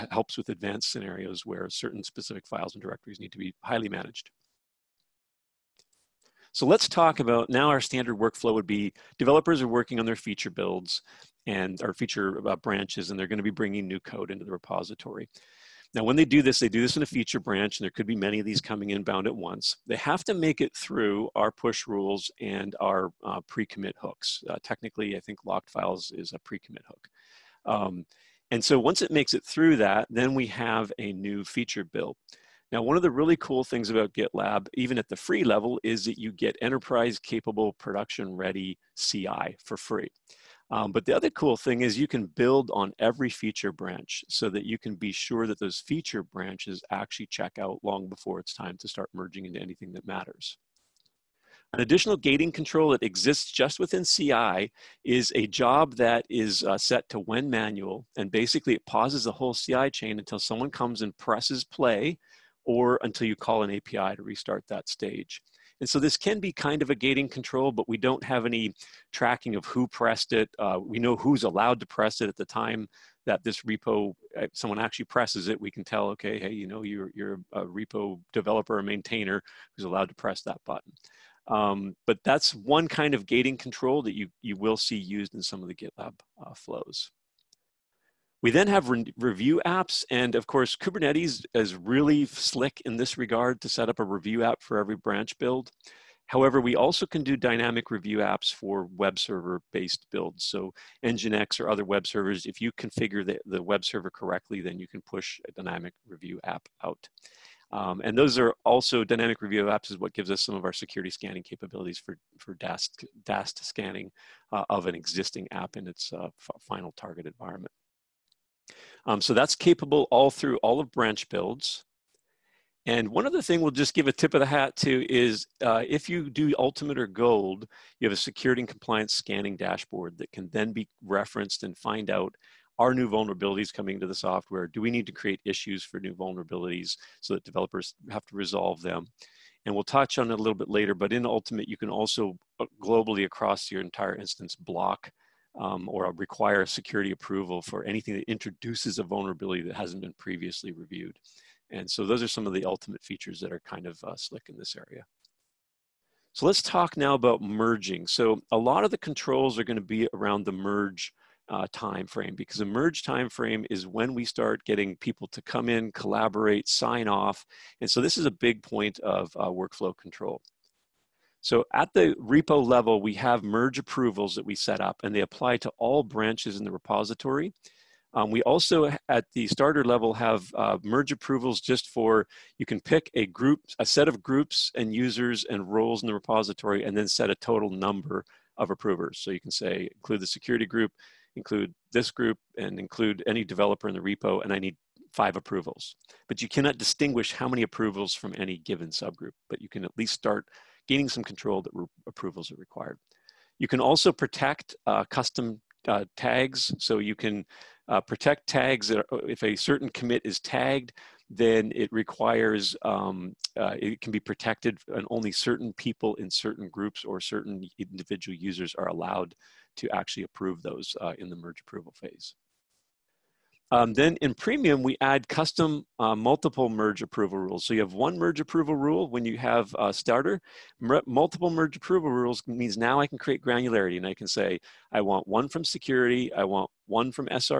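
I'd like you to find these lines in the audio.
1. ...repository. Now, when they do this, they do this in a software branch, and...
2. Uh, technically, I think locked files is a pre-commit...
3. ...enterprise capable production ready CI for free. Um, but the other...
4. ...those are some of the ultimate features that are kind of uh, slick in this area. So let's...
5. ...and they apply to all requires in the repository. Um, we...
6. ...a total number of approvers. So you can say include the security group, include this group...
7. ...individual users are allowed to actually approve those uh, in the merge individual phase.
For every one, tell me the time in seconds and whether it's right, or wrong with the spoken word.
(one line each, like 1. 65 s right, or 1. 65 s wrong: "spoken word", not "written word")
1. 14 s wrong: "feature", not "software"
2. 24 s right
3. 36 s right
4. 152 s right
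5. 175 s wrong: "branches", not "requires"
6. 187 s right
7. 217 s wrong: "approval", not "individual".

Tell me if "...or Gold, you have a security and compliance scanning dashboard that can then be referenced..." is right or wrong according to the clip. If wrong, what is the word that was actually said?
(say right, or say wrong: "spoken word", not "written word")
right.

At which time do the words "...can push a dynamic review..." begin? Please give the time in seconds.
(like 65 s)
104 s.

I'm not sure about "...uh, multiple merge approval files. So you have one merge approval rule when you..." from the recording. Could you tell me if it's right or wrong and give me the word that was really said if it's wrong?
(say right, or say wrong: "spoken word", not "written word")
wrong: "rules", not "files".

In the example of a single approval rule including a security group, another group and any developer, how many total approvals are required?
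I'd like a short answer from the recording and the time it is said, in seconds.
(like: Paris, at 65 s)
5, at 195 s.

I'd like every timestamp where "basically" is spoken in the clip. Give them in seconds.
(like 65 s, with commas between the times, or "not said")
58 s.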